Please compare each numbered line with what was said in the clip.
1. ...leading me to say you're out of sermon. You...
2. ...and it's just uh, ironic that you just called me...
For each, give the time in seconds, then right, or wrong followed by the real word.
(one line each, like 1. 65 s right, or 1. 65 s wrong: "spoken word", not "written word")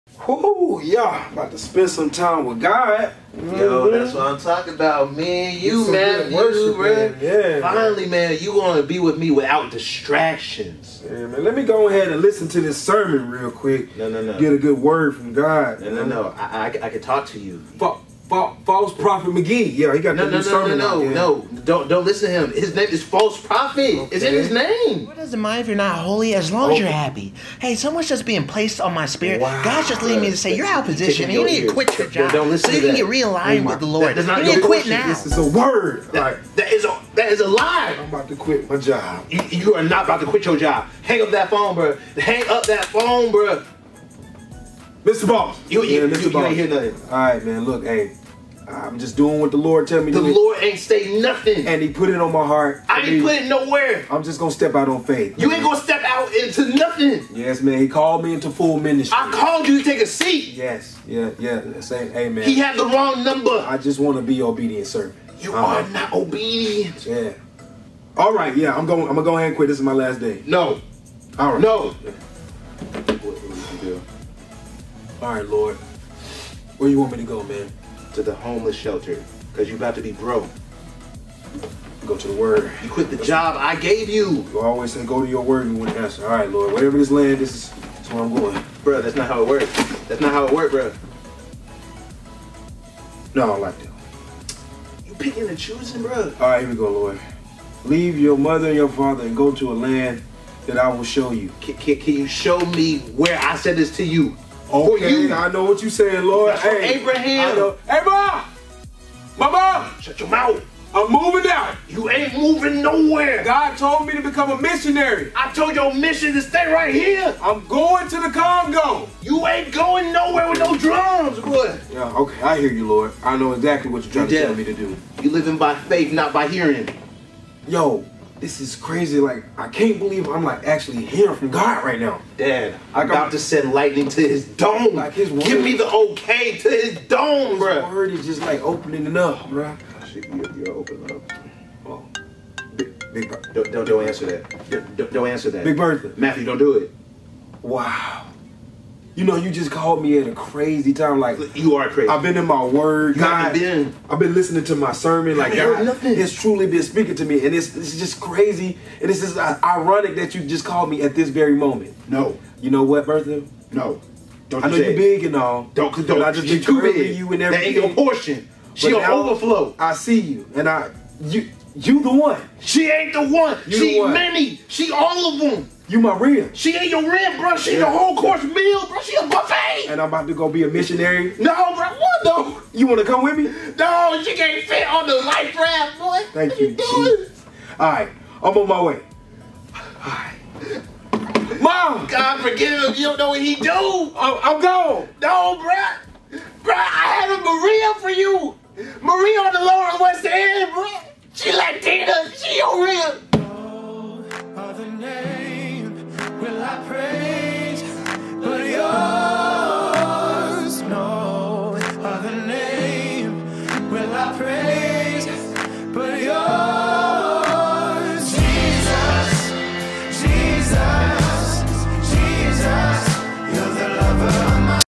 1. 30 s wrong: "position", not "sermon"
2. 158 s right.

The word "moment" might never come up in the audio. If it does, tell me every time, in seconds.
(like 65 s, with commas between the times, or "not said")
161 s.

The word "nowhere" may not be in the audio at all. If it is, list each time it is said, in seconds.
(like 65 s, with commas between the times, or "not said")
53 s, 112 s, 120 s.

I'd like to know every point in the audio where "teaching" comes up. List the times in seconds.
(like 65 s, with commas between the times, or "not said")
not said.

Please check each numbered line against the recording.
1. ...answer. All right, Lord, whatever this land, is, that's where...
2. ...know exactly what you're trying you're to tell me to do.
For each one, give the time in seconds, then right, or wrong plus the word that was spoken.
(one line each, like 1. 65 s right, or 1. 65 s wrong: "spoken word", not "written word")
1. 85 s right
2. 123 s right.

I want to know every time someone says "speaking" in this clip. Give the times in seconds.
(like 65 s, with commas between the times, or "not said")
156 s.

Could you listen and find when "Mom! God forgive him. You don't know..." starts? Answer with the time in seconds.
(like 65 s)
191 s.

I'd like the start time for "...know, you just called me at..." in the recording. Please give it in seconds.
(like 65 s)
149 s.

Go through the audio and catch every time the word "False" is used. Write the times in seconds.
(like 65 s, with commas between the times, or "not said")
18 s, 23 s.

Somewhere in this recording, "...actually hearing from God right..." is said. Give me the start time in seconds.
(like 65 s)
130 s.